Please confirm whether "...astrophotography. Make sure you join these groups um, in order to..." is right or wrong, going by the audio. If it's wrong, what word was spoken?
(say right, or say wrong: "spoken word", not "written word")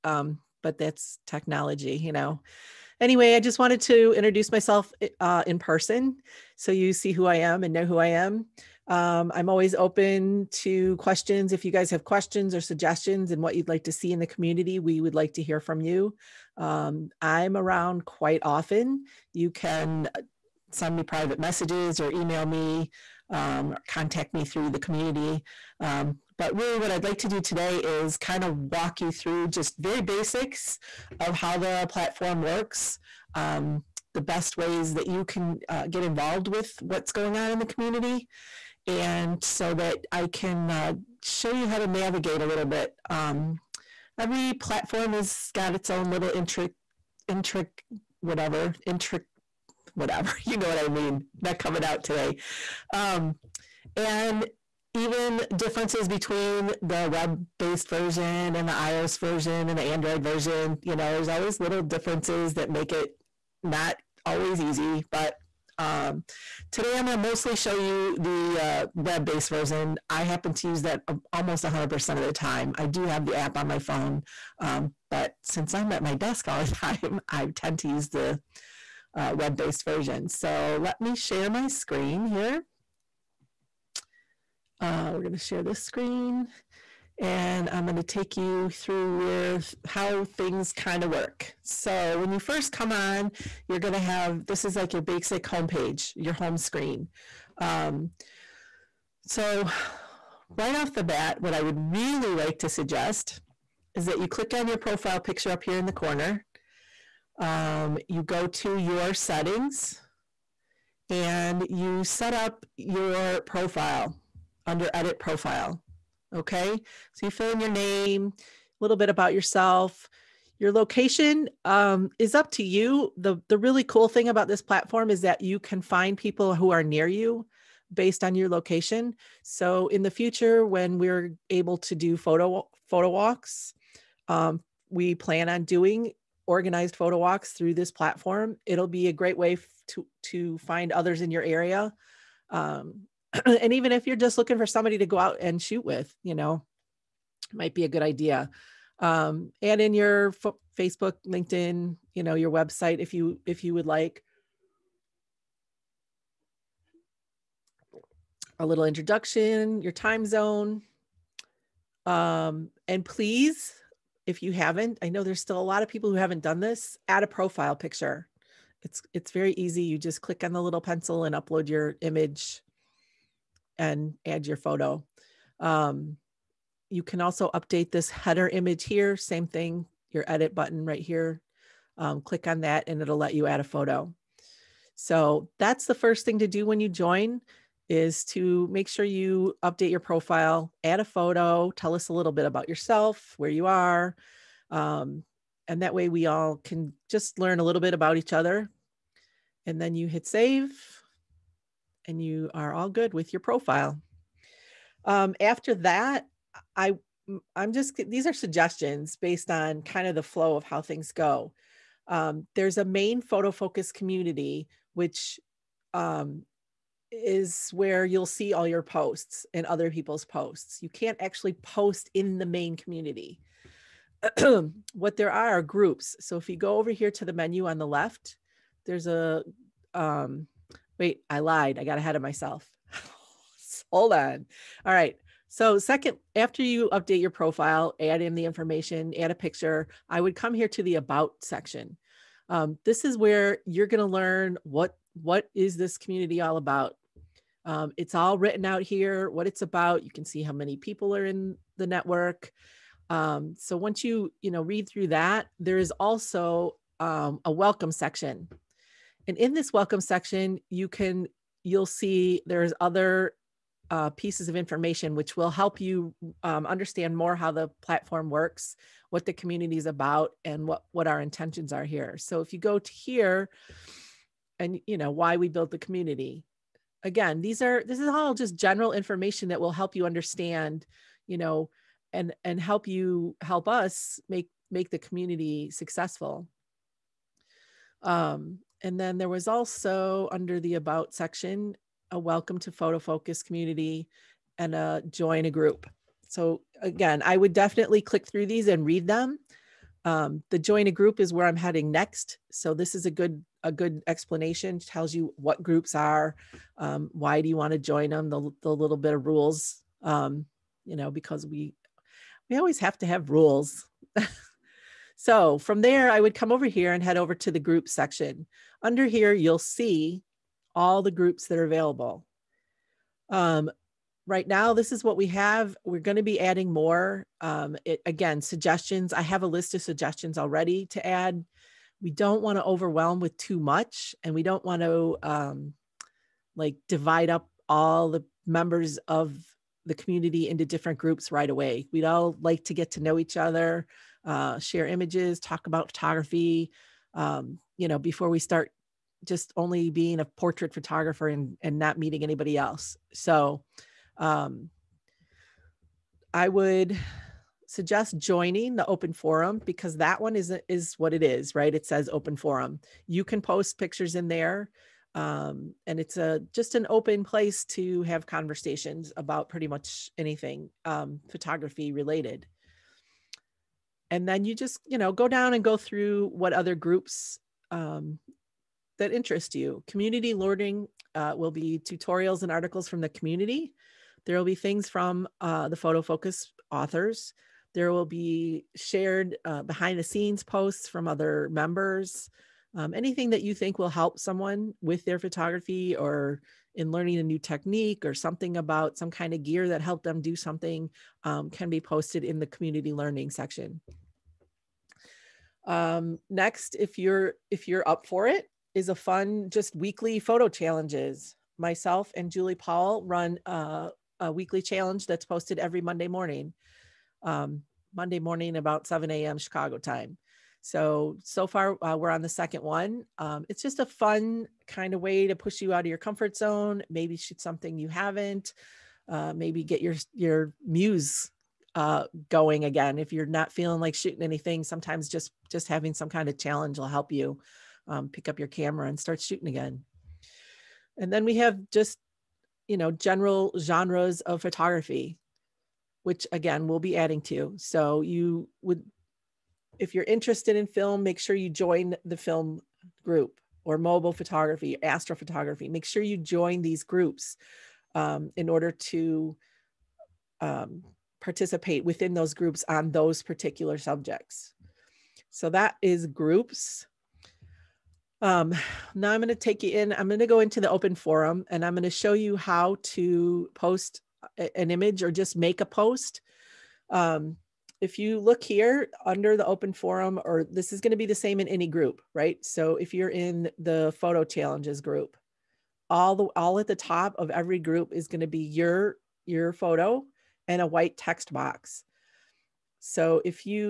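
right.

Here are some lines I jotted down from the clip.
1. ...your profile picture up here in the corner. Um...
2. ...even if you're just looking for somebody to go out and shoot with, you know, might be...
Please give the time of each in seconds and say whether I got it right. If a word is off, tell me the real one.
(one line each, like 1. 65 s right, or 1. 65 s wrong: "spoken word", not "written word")
1. 104 s right
2. 143 s right.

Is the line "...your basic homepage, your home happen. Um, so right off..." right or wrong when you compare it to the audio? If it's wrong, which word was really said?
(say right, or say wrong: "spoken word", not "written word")
wrong: "screen", not "happen".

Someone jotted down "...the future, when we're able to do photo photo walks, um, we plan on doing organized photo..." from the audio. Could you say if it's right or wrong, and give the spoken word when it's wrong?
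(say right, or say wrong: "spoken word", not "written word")
right.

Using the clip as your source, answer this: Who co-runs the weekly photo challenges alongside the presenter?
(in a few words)
Julie Paul.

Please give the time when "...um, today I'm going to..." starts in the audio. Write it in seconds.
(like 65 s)
65 s.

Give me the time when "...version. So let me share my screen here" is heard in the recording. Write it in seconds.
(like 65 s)
79 s.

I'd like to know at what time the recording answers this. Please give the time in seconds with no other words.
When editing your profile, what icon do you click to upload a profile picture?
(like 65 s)
170 s.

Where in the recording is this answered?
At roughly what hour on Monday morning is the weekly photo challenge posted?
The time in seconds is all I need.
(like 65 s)
418 s.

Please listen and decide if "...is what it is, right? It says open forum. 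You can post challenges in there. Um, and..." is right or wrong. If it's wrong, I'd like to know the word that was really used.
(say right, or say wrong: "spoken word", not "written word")
wrong: "pictures", not "challenges".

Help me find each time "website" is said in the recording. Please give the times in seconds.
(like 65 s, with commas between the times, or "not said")
152 s.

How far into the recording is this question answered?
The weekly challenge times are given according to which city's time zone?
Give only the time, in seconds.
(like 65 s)
419 s.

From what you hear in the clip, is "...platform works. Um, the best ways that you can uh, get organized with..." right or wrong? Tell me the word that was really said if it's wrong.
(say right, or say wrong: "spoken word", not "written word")
wrong: "involved", not "organized".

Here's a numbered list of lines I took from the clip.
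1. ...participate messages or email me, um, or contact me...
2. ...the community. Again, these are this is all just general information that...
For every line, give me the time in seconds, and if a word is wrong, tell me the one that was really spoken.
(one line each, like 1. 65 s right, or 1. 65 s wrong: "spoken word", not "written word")
1. 21 s wrong: "private", not "participate"
2. 275 s right.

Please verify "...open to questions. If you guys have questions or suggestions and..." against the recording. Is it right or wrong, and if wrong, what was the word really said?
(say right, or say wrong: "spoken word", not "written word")
right.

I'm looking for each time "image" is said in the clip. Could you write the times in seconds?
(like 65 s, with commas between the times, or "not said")
172 s, 178 s, 344 s, 474 s.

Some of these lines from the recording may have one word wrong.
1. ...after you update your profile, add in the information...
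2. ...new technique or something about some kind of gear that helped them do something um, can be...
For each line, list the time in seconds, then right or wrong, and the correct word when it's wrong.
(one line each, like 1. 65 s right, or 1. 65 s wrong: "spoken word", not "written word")
1. 236 s right
2. 397 s right.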